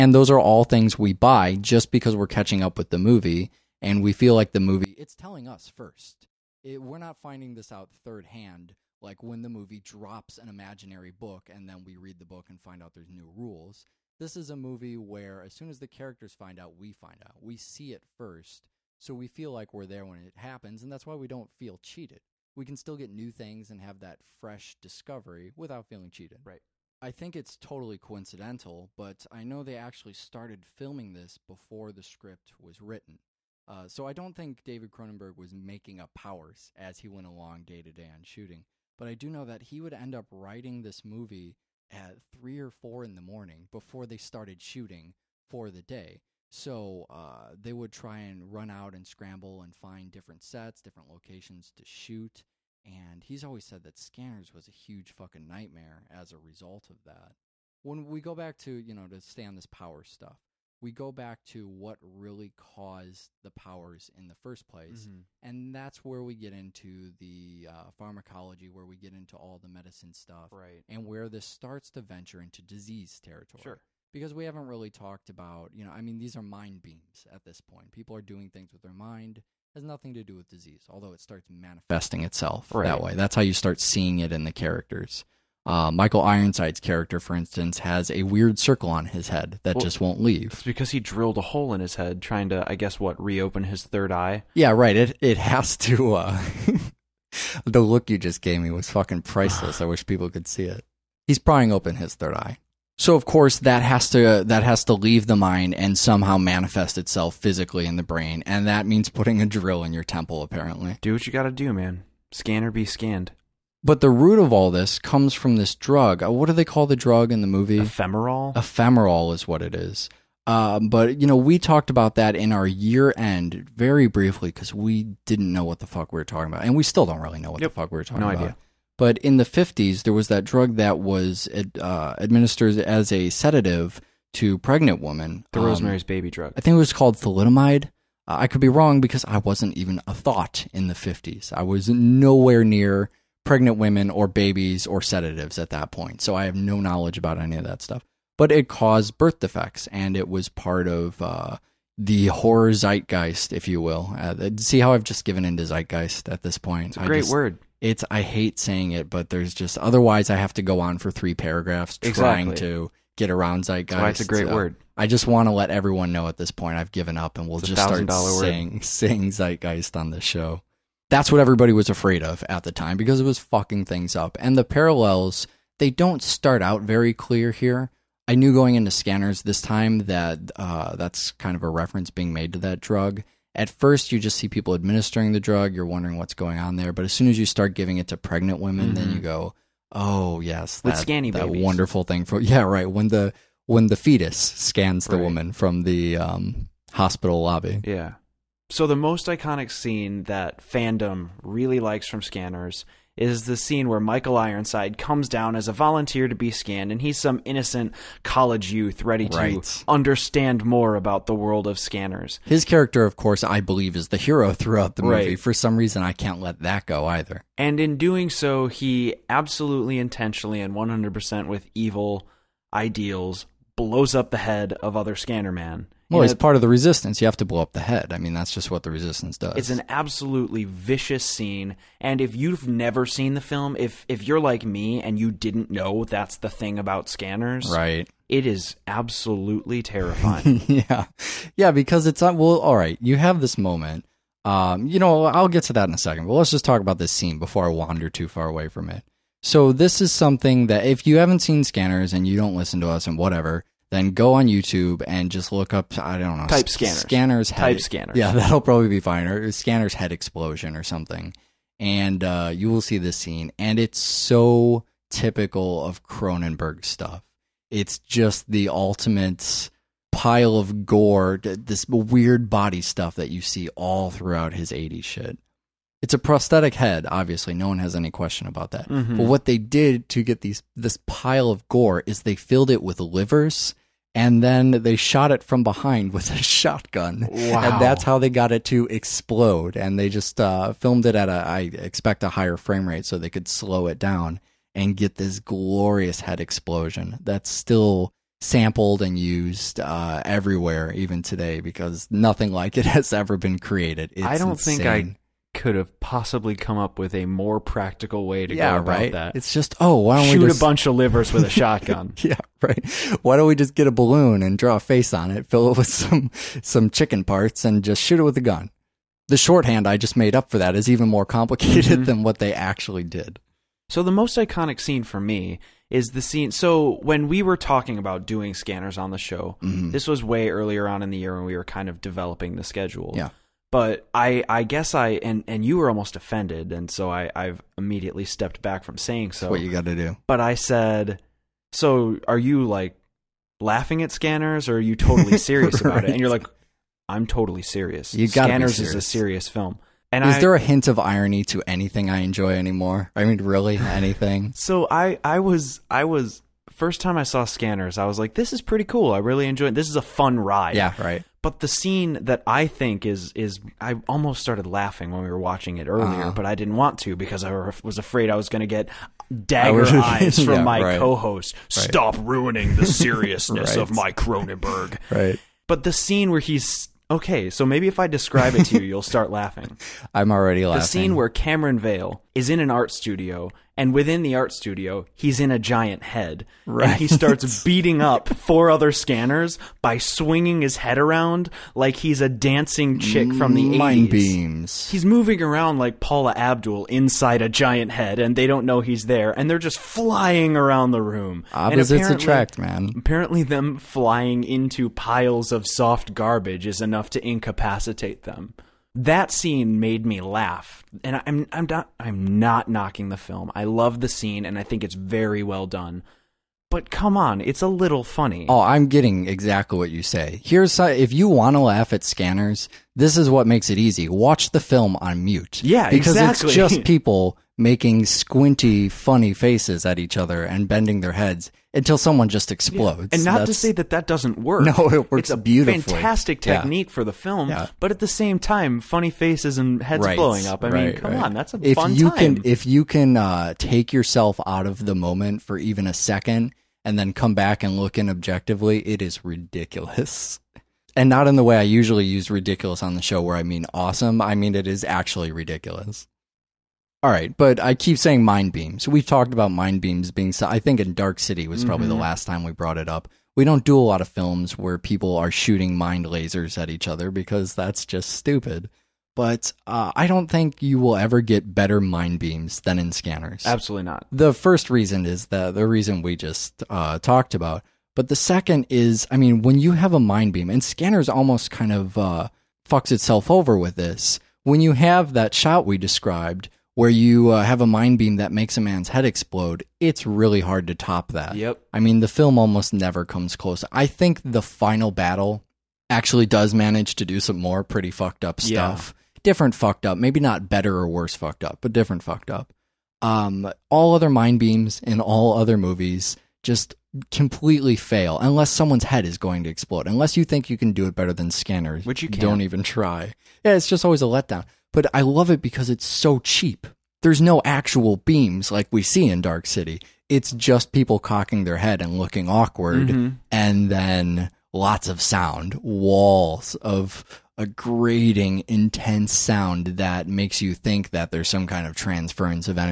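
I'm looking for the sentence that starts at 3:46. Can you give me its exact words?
Well, it's part of the resistance.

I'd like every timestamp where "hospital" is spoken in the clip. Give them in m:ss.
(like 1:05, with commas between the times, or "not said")
3:16.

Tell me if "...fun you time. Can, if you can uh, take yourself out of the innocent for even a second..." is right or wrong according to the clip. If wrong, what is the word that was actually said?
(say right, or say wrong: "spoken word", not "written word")
wrong: "moment", not "innocent".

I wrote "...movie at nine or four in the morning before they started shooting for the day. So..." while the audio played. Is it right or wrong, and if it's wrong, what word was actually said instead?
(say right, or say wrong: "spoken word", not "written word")
wrong: "three", not "nine".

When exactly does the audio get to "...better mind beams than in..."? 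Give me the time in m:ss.
7:51.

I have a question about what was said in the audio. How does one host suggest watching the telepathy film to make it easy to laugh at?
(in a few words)
on mute.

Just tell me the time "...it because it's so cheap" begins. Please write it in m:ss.
8:35.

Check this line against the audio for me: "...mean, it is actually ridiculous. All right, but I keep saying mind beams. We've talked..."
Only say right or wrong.
right.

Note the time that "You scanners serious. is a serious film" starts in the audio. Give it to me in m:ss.
5:48.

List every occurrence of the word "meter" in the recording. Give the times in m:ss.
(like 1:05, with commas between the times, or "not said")
not said.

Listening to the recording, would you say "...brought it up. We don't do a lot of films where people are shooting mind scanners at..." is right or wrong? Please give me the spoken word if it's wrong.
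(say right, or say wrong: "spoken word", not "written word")
wrong: "lasers", not "scanners".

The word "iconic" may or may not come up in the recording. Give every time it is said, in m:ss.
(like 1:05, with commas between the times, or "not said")
3:19, 5:24.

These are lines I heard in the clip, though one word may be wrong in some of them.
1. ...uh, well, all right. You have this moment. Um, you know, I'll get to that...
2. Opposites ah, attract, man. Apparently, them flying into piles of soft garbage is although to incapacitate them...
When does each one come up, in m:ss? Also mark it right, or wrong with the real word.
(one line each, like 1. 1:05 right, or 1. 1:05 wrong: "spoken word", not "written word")
1. 4:02 right
2. 6:41 wrong: "enough", not "although".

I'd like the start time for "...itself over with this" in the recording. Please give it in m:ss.
8:02.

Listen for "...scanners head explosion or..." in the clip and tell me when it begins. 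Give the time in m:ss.
4:19.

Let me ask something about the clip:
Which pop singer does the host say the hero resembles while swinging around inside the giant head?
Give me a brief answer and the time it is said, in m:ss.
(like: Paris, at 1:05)
Paula Abdul, at 6:35.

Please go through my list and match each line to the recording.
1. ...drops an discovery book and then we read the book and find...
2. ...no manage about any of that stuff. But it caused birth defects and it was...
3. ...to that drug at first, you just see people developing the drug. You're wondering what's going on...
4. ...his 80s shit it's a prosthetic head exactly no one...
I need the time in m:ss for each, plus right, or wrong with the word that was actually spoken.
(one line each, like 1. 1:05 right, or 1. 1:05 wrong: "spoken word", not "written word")
1. 0:09 wrong: "imaginary", not "discovery"
2. 2:26 wrong: "knowledge", not "manage"
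3. 3:02 wrong: "administering", not "developing"
4. 4:34 wrong: "obviously", not "exactly".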